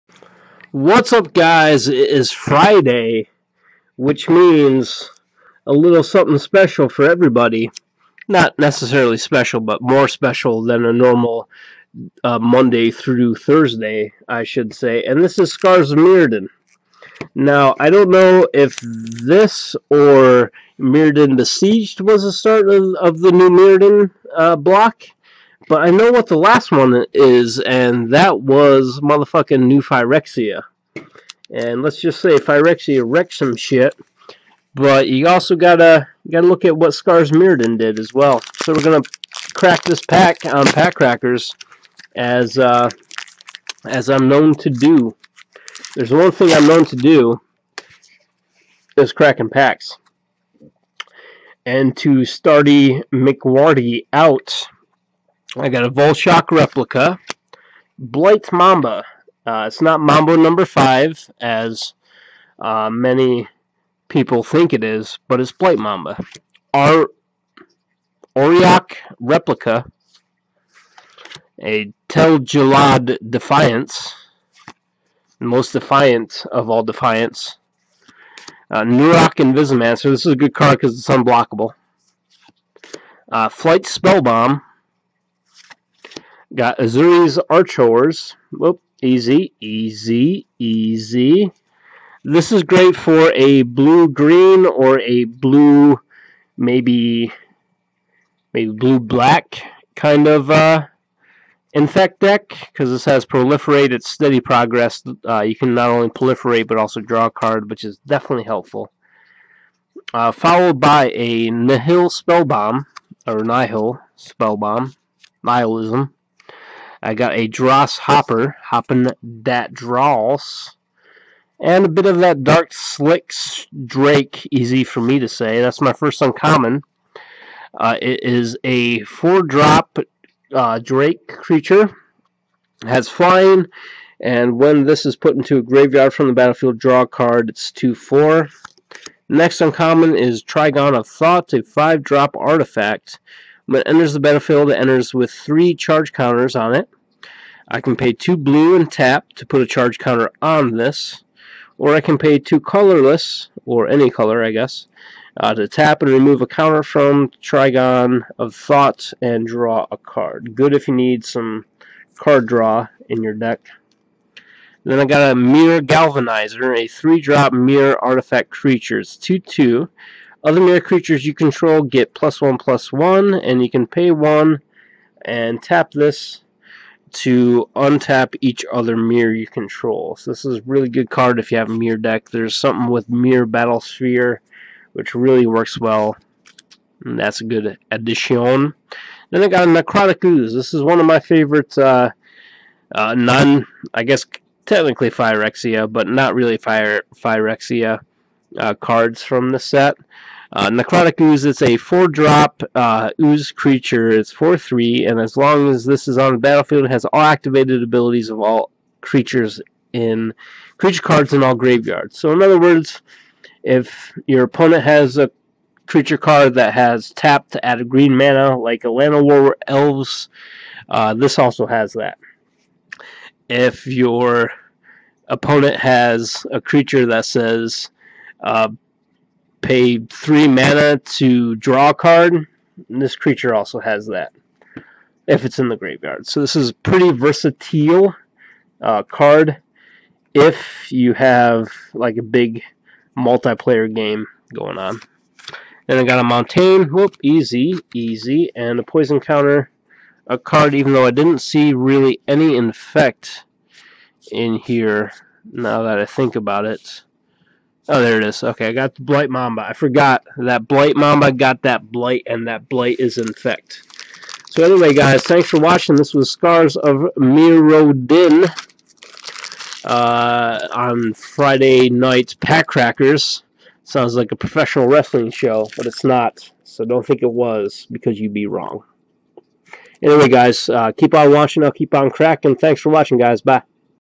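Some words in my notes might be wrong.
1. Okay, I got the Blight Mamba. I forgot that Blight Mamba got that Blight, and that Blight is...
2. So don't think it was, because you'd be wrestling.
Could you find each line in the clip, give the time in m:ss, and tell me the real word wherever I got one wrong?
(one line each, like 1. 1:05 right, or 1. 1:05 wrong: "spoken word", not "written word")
1. 4:18 right
2. 4:36 wrong: "wrong", not "wrestling".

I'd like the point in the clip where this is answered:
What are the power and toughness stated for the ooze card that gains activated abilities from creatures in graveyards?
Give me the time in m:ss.
3:24.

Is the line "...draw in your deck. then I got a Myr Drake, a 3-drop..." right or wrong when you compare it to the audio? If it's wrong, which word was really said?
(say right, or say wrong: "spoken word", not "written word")
wrong: "Galvanizer", not "Drake".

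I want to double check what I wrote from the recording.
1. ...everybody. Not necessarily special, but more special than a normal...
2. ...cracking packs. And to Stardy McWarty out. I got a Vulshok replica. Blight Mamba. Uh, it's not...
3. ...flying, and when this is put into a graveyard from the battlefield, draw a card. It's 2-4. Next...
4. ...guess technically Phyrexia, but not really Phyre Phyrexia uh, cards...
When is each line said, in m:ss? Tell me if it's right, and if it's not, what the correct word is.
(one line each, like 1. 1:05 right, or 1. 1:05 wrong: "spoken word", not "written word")
1. 0:07 right
2. 0:49 right
3. 2:13 right
4. 3:14 right.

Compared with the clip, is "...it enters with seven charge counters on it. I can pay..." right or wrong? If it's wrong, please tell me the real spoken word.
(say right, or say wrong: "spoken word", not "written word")
wrong: "three", not "seven".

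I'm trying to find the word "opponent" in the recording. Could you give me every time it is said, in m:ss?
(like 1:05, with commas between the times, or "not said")
3:34, 3:45.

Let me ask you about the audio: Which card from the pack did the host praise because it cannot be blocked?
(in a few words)
Neurok Invisimancer.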